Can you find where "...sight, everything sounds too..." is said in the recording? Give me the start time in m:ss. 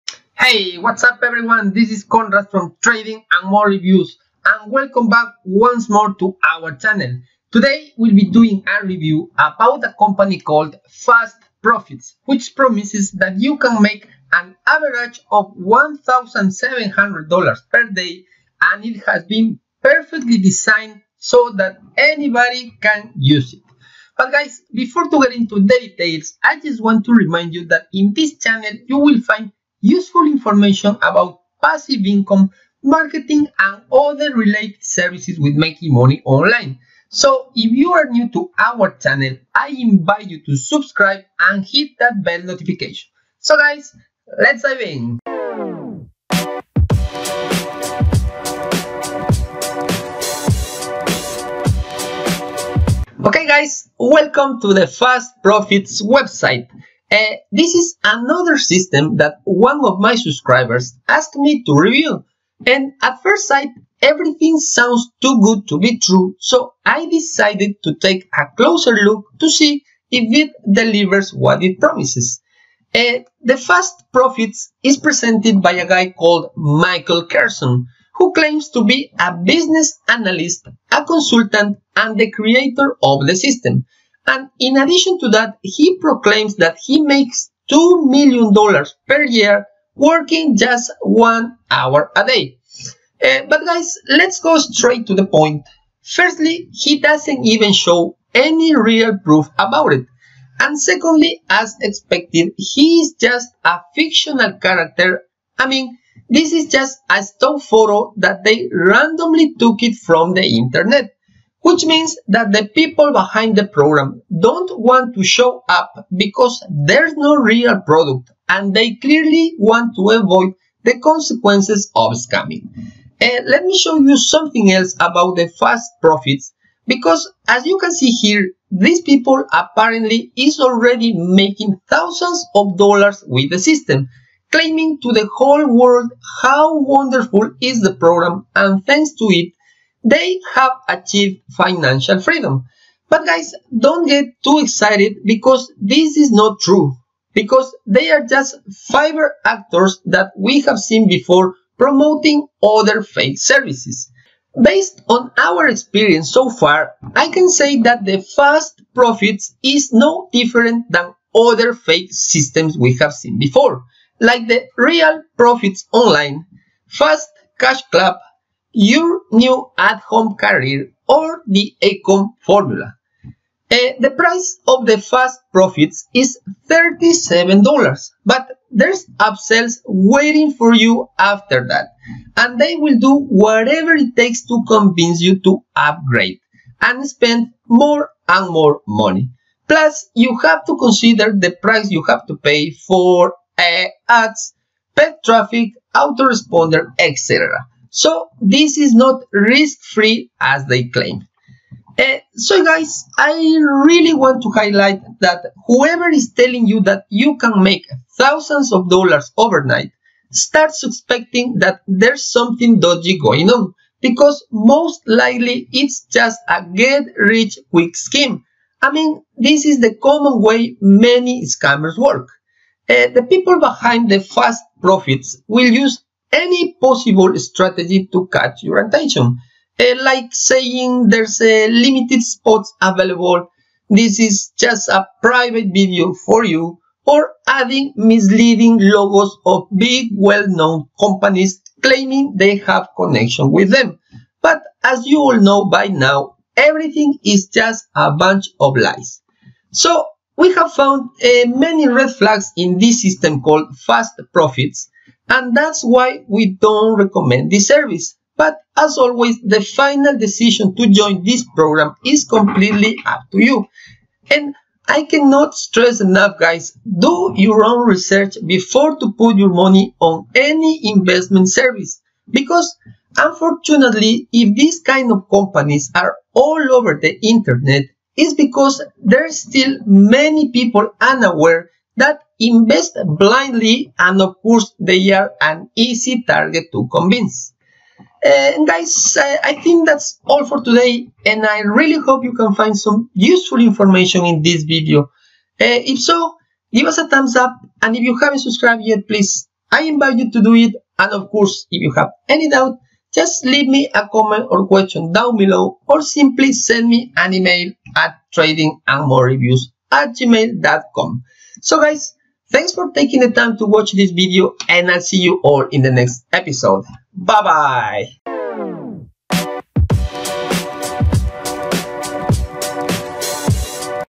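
1:03.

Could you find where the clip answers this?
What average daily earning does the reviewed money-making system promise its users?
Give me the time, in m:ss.
0:15.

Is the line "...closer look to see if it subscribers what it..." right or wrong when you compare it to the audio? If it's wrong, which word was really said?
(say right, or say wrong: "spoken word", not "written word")
wrong: "delivers", not "subscribers".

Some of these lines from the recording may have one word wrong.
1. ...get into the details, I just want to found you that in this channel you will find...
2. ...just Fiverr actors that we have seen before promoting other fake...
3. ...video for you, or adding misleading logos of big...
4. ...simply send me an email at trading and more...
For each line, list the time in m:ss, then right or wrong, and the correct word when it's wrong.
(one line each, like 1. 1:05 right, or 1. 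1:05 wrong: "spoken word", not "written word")
1. 0:25 wrong: "remind", not "found"
2. 2:28 right
3. 3:55 right
4. 5:06 right.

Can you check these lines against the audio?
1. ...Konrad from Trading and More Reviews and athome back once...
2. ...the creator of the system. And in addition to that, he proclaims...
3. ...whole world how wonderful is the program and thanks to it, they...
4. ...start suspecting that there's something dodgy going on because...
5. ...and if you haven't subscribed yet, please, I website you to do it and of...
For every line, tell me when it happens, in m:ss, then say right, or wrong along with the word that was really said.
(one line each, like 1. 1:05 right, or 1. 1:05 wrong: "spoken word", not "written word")
1. 0:02 wrong: "welcome", not "athome"
2. 1:22 right
3. 2:15 right
4. 3:30 right
5. 4:57 wrong: "invite", not "website".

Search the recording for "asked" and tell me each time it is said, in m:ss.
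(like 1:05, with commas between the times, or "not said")
1:01.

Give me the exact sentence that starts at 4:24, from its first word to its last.
And I cannot stress enough, guys, do your own research before to put your money on any investment service.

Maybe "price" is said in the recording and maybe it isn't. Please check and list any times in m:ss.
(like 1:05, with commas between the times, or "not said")
2:54, 3:11.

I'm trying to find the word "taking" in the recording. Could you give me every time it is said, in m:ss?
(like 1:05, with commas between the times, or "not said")
5:12.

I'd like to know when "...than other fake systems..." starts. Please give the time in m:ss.
2:40.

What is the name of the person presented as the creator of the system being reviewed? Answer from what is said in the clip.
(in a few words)
Michael Carson.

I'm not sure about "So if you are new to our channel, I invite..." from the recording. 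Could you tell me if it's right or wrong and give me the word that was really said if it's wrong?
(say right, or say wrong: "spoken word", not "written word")
right.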